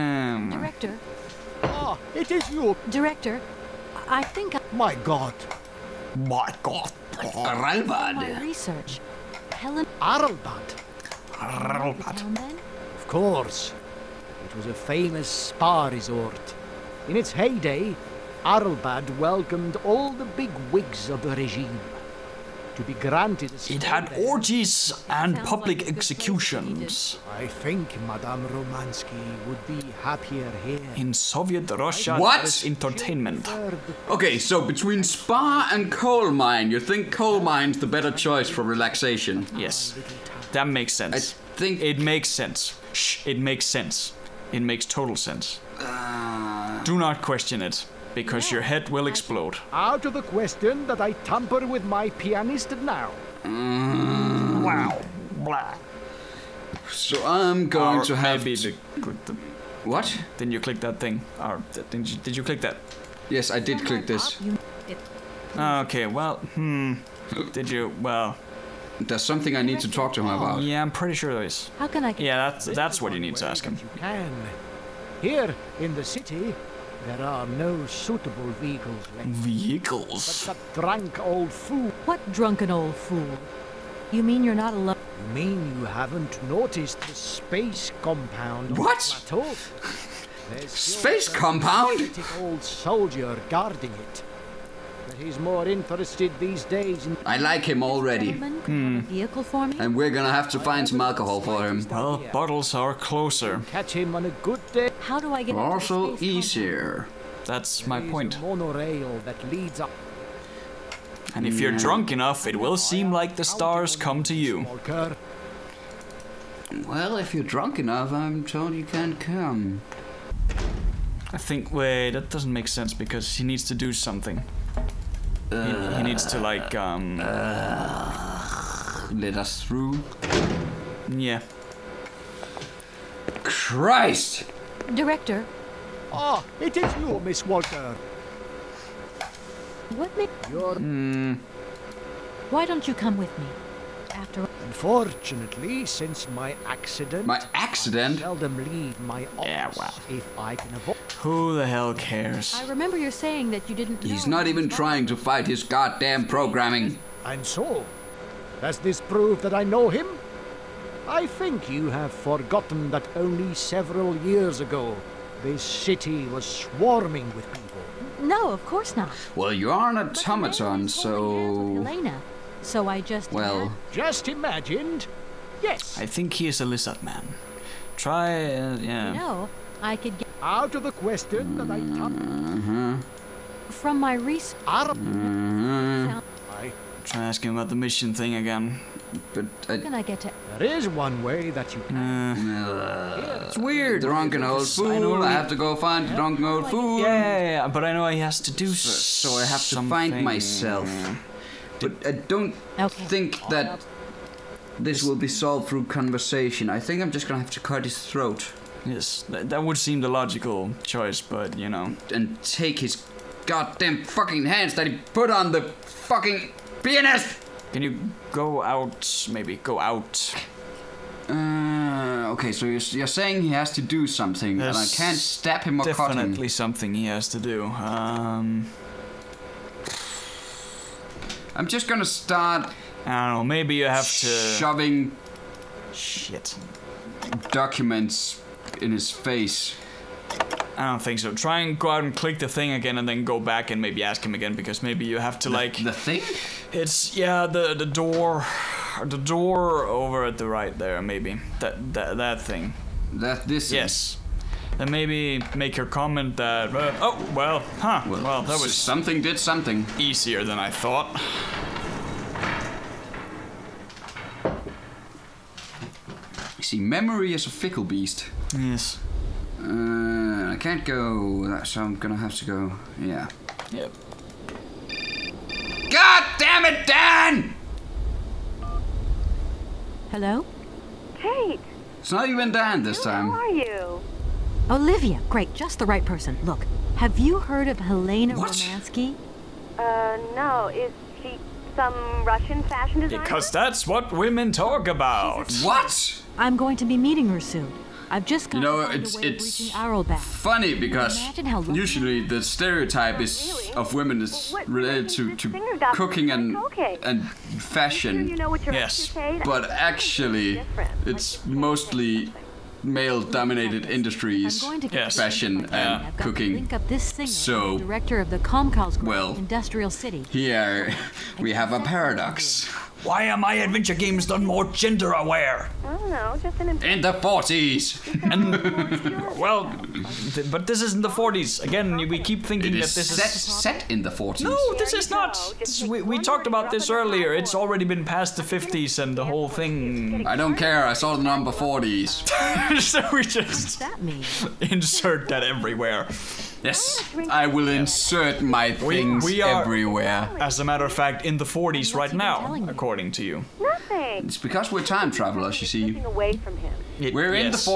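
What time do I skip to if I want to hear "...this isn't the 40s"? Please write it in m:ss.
5:30.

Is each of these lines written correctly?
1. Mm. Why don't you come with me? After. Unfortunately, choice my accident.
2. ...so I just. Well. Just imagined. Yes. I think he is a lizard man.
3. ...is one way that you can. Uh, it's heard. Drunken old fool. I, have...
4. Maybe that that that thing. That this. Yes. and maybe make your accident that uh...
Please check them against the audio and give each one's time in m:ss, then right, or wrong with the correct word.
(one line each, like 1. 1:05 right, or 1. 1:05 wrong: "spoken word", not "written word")
1. 2:20 wrong: "since", not "choice"
2. 2:52 right
3. 3:10 wrong: "weird", not "heard"
4. 4:11 wrong: "comment", not "accident".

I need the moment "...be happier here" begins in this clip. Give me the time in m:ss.
0:29.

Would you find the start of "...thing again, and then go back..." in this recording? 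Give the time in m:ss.
4:02.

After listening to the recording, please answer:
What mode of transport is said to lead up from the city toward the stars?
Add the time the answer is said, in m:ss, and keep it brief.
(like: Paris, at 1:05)
Monorail, at 1:48.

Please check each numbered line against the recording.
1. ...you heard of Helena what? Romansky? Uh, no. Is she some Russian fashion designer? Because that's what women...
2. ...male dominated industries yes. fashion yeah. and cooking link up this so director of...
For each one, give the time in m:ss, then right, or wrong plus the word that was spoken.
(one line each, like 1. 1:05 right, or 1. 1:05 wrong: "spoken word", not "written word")
1. 4:47 right
2. 5:12 right.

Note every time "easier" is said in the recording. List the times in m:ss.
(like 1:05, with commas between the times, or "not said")
1:46, 4:19.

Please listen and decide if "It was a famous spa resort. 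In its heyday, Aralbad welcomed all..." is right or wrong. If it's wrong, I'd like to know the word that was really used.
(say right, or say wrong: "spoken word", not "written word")
right.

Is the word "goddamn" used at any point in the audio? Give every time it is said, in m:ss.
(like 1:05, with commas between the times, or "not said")
2:35, 3:33.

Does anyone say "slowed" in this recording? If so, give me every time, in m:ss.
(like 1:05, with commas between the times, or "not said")
not said.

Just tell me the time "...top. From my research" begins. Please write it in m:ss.
3:01.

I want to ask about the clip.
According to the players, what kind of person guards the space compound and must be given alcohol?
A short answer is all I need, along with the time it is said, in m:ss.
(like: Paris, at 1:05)
Old soldier, at 1:32.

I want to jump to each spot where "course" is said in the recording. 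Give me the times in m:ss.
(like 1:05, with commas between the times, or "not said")
0:13, 2:48.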